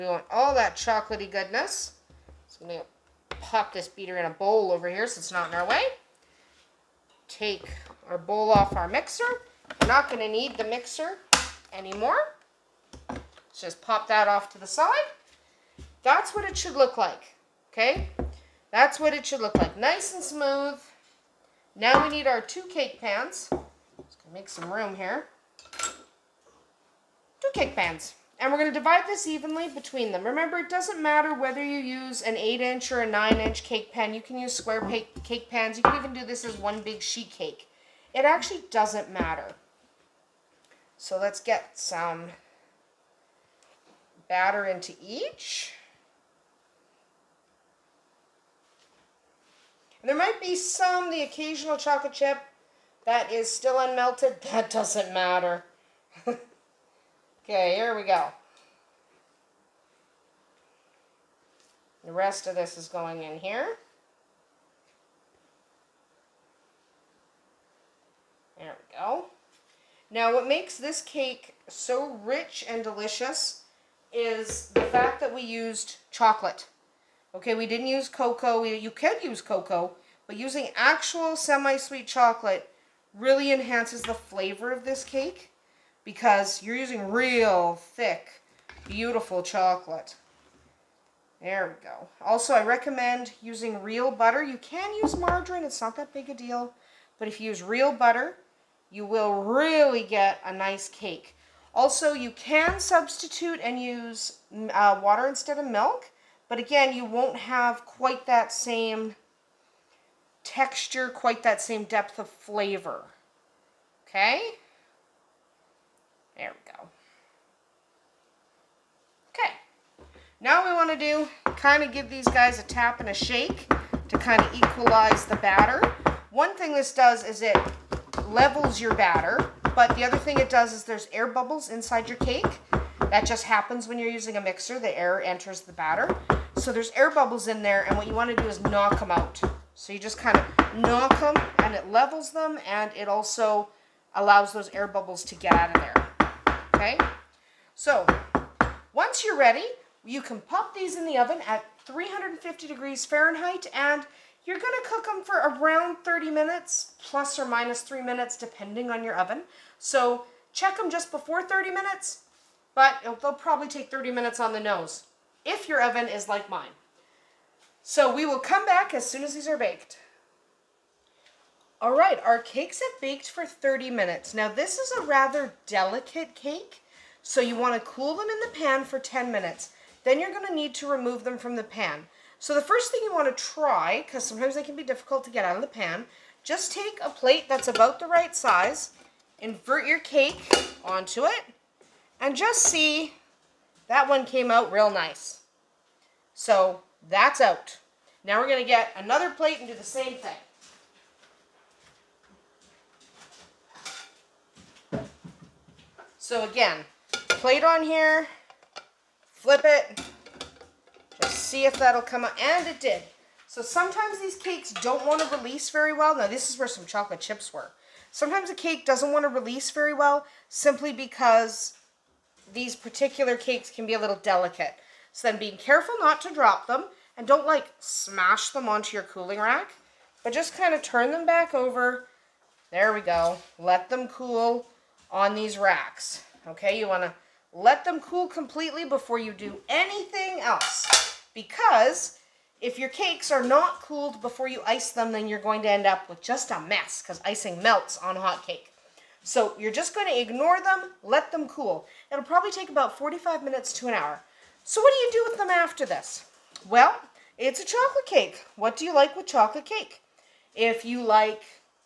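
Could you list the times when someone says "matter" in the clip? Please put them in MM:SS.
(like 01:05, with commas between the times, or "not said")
00:31, 00:39, 00:55.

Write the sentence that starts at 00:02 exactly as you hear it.
So I'm going to pop this beater in a bowl over here so it's not in our way.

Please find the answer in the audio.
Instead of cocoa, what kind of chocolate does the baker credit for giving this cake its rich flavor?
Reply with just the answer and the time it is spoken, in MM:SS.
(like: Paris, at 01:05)
semi-sweet chocolate, at 01:21.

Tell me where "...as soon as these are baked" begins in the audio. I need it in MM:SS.
02:48.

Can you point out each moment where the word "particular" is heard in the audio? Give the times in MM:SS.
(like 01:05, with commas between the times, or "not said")
03:42.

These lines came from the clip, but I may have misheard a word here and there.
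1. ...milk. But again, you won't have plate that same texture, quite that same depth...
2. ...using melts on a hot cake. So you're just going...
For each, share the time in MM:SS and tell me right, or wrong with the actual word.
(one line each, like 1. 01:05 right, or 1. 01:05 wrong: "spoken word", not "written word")
1. 01:45 wrong: "quite", not "plate"
2. 04:07 wrong: "icing", not "using".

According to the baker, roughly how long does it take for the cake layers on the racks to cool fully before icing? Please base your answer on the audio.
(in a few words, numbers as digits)
45 minutes to an hour.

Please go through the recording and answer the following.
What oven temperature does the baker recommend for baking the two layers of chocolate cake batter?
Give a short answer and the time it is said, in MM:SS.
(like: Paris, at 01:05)
350 degrees Fahrenheit, at 02:31.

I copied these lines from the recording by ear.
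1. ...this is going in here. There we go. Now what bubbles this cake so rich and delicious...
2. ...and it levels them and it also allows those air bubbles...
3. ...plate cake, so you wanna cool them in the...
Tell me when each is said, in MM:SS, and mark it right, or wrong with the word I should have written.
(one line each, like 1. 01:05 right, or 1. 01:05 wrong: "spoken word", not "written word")
1. 01:02 wrong: "makes", not "bubbles"
2. 02:21 right
3. 02:55 wrong: "delicate", not "plate".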